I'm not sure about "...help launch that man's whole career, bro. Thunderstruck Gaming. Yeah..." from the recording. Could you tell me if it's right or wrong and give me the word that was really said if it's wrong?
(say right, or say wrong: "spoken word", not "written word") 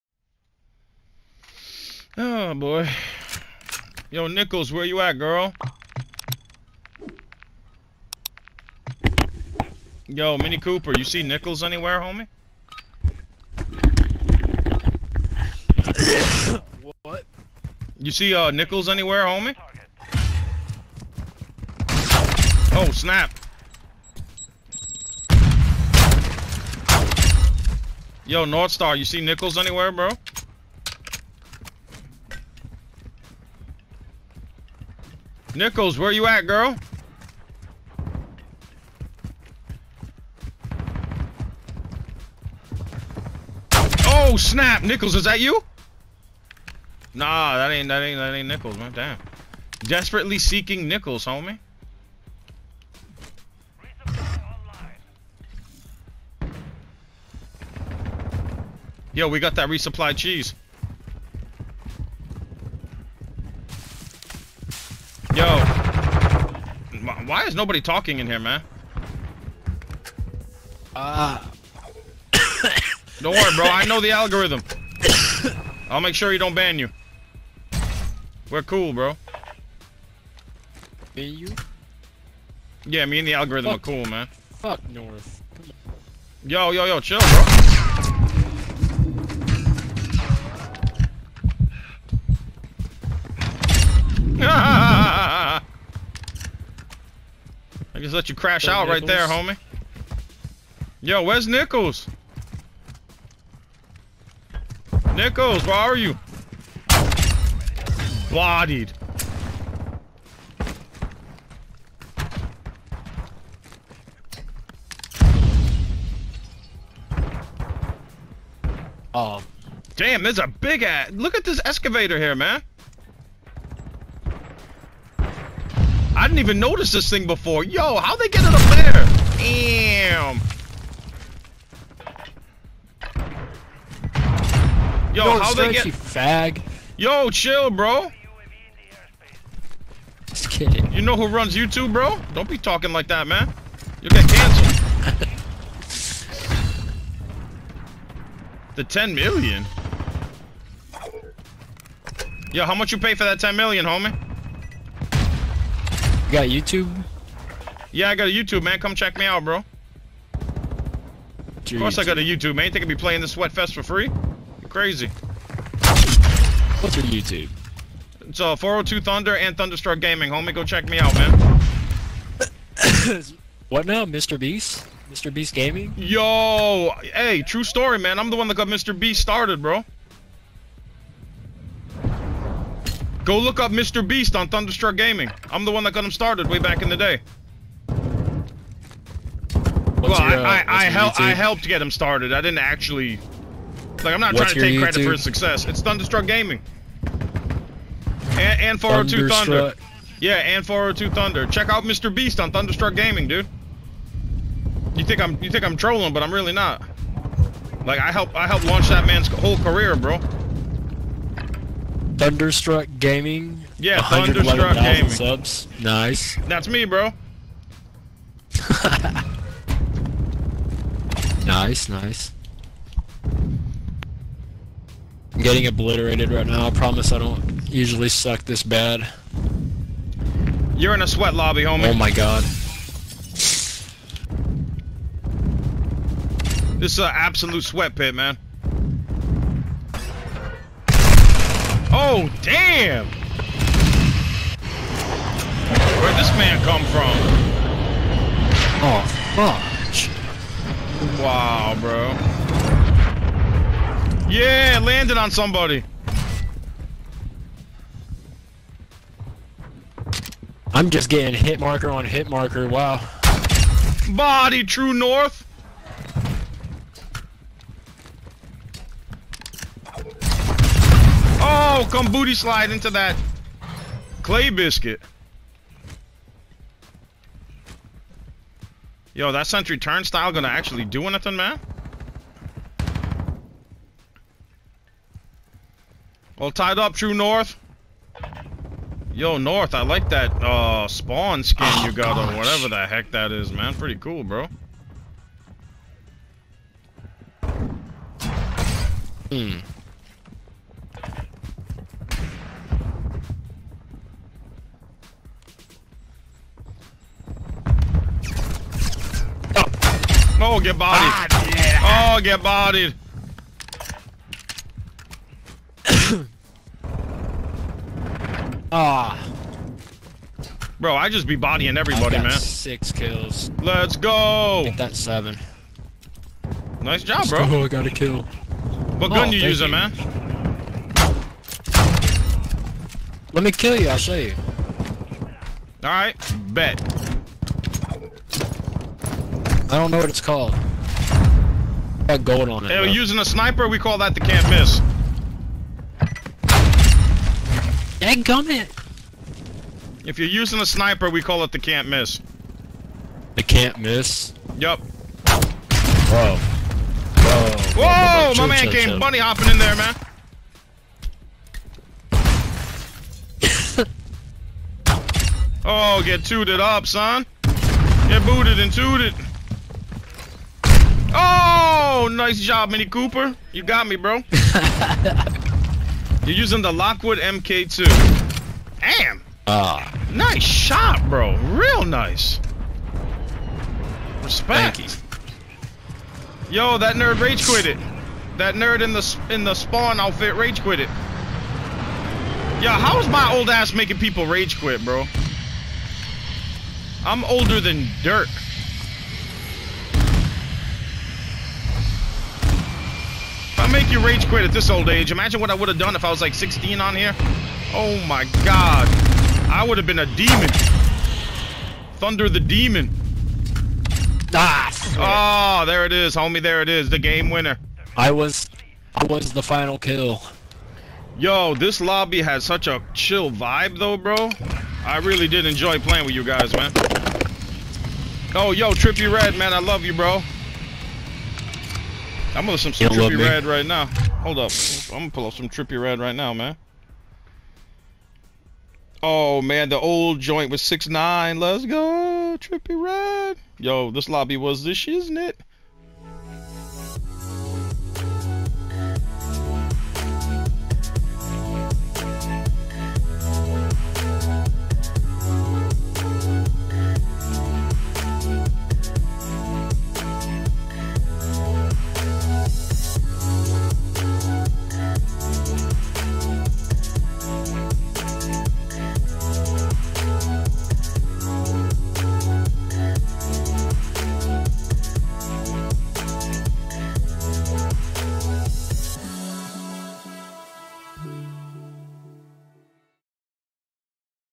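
right.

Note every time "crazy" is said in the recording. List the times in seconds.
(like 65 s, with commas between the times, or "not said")
164 s.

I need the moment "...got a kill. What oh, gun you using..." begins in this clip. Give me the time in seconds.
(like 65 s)
327 s.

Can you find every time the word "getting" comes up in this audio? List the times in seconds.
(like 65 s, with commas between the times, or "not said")
225 s, 261 s.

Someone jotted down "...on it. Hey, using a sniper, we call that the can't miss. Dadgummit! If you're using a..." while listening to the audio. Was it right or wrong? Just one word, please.
right.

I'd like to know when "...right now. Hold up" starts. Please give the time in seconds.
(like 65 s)
433 s.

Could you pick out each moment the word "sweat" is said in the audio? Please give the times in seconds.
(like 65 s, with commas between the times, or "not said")
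163 s, 231 s, 237 s.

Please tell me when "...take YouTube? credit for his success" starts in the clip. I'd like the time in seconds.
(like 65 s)
194 s.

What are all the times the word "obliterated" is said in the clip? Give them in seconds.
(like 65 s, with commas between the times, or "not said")
225 s.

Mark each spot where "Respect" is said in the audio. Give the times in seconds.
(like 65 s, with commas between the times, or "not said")
384 s.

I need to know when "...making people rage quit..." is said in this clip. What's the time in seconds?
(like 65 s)
393 s.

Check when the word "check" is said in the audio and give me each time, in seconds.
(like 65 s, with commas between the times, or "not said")
158 s, 170 s, 201 s.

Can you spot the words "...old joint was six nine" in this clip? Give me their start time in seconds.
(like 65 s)
439 s.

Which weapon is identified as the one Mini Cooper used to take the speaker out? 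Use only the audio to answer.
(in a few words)
Lockwood MK2.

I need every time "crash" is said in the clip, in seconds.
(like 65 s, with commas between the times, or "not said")
98 s.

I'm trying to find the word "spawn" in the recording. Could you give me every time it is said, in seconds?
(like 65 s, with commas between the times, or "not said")
290 s, 389 s.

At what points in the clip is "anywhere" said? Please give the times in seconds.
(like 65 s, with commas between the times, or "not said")
11 s, 18 s, 29 s.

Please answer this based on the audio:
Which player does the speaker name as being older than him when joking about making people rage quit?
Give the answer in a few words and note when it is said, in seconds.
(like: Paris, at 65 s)
Dirk, at 398 s.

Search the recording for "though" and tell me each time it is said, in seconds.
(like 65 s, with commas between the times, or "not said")
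423 s.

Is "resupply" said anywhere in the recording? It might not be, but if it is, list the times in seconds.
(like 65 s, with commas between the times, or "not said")
59 s.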